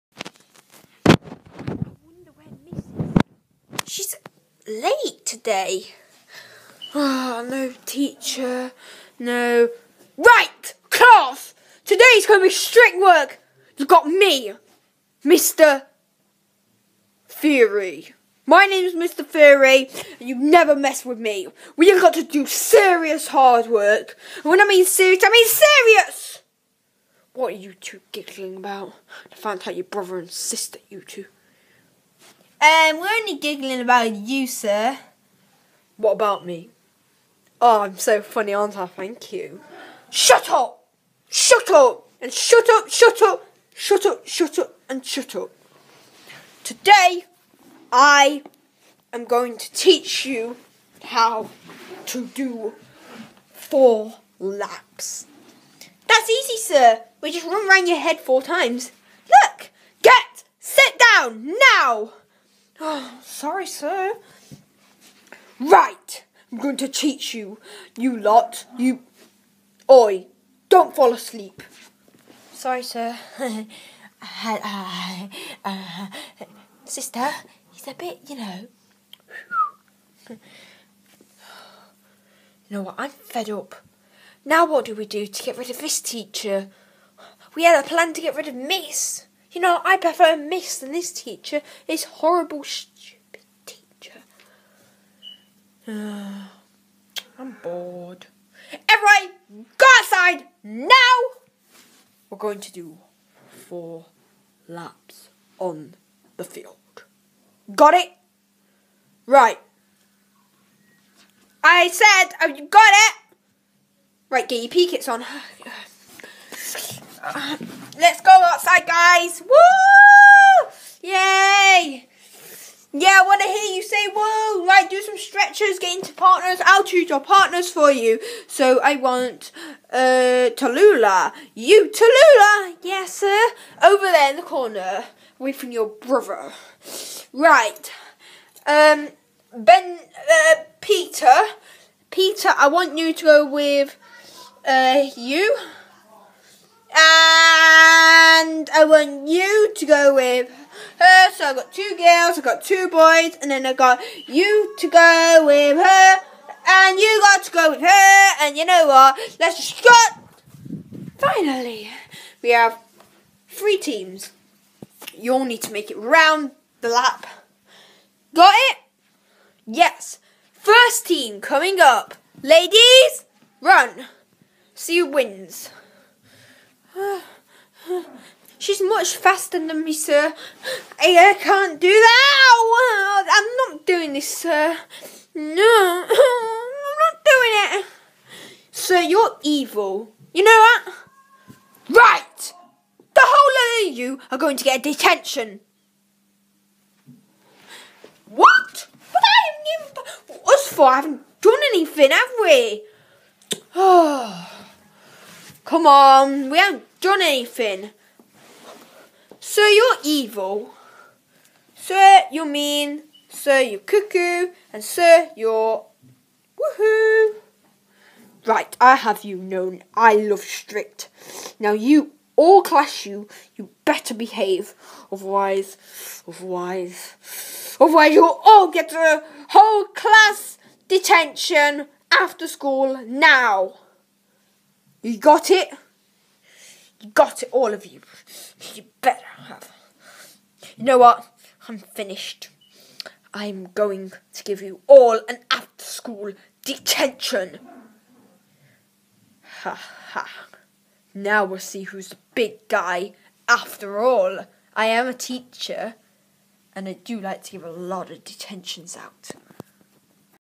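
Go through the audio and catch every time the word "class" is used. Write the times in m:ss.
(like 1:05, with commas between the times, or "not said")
0:10, 3:42, 3:49.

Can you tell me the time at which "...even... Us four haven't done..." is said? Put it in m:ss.
3:20.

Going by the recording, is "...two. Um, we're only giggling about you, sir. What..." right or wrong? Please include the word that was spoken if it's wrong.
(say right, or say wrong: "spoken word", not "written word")
right.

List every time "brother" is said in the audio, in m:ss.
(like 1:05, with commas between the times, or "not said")
0:29, 2:15.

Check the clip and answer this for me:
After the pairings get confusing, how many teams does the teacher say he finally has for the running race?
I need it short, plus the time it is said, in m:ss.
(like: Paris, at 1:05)
3, at 2:43.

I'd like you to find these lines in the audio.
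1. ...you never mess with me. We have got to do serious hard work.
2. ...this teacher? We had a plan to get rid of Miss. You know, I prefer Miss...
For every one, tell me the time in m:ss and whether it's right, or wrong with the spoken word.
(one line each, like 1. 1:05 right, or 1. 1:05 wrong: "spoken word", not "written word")
1. 0:20 right
2. 1:25 right.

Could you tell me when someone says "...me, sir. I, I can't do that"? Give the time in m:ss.
2:59.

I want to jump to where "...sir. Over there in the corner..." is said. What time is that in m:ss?
2:13.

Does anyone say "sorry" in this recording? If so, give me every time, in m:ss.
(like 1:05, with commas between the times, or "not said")
1:03, 1:12.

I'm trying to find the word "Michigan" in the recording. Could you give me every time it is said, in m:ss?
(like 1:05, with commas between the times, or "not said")
not said.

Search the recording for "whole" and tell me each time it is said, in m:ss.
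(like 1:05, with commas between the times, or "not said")
3:13, 3:49.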